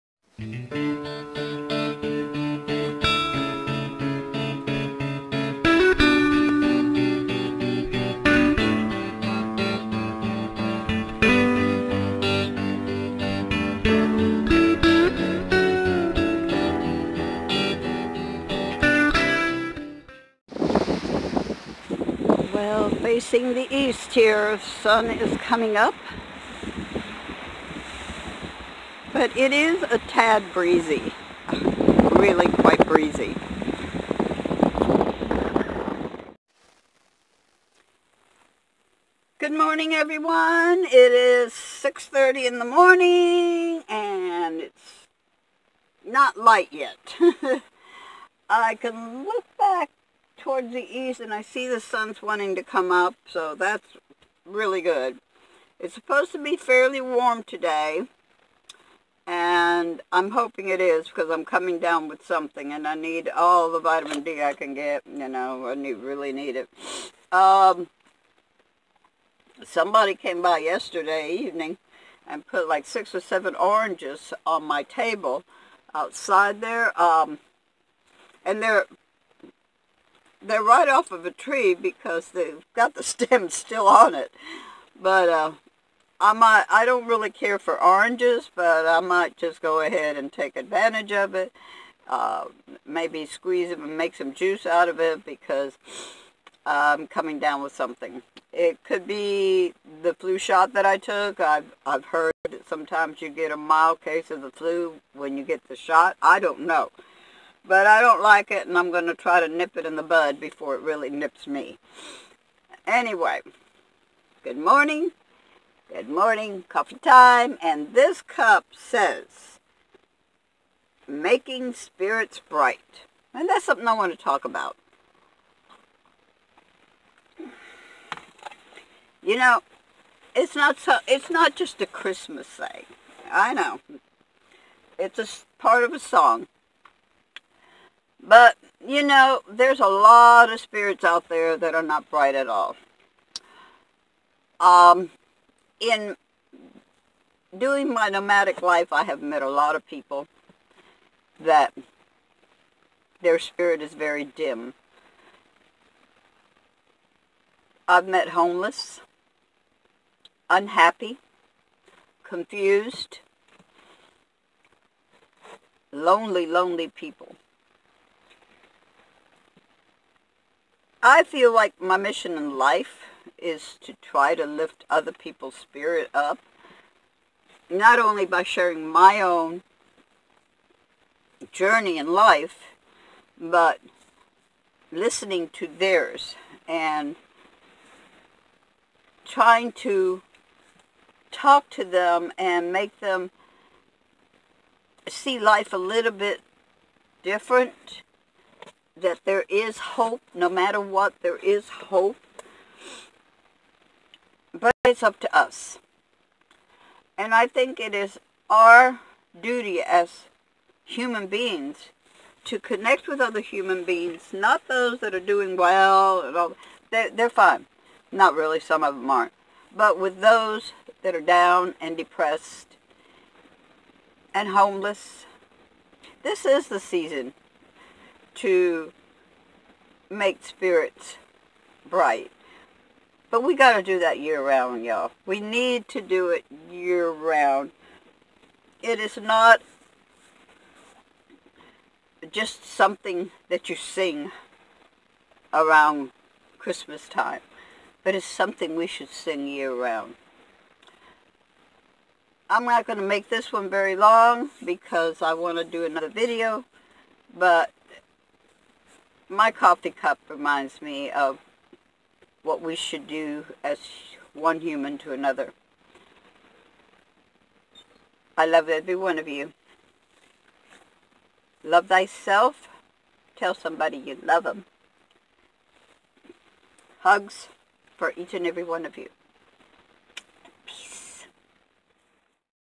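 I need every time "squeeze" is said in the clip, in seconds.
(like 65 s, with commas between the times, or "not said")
93 s.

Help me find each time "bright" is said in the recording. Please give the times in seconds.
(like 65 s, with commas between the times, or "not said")
122 s, 142 s, 231 s.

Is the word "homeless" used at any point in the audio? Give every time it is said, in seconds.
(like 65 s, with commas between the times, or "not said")
158 s, 224 s.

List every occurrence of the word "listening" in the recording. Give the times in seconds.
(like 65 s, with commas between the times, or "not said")
184 s.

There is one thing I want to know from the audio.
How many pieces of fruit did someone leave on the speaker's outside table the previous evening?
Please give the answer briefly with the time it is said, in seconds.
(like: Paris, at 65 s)
6 or 7, at 72 s.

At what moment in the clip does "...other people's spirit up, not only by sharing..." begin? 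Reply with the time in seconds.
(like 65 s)
174 s.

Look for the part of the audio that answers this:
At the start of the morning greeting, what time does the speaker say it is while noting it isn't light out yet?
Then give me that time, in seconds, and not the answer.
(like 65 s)
41 s.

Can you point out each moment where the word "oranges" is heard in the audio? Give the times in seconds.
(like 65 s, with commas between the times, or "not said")
73 s, 87 s.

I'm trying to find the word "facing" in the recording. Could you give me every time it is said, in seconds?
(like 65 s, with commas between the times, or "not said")
23 s.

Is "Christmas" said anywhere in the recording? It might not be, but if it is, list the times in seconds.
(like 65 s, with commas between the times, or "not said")
131 s, 246 s.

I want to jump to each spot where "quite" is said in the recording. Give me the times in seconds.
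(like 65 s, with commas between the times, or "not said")
32 s.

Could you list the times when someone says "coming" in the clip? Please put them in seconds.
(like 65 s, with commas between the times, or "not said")
25 s, 61 s, 97 s.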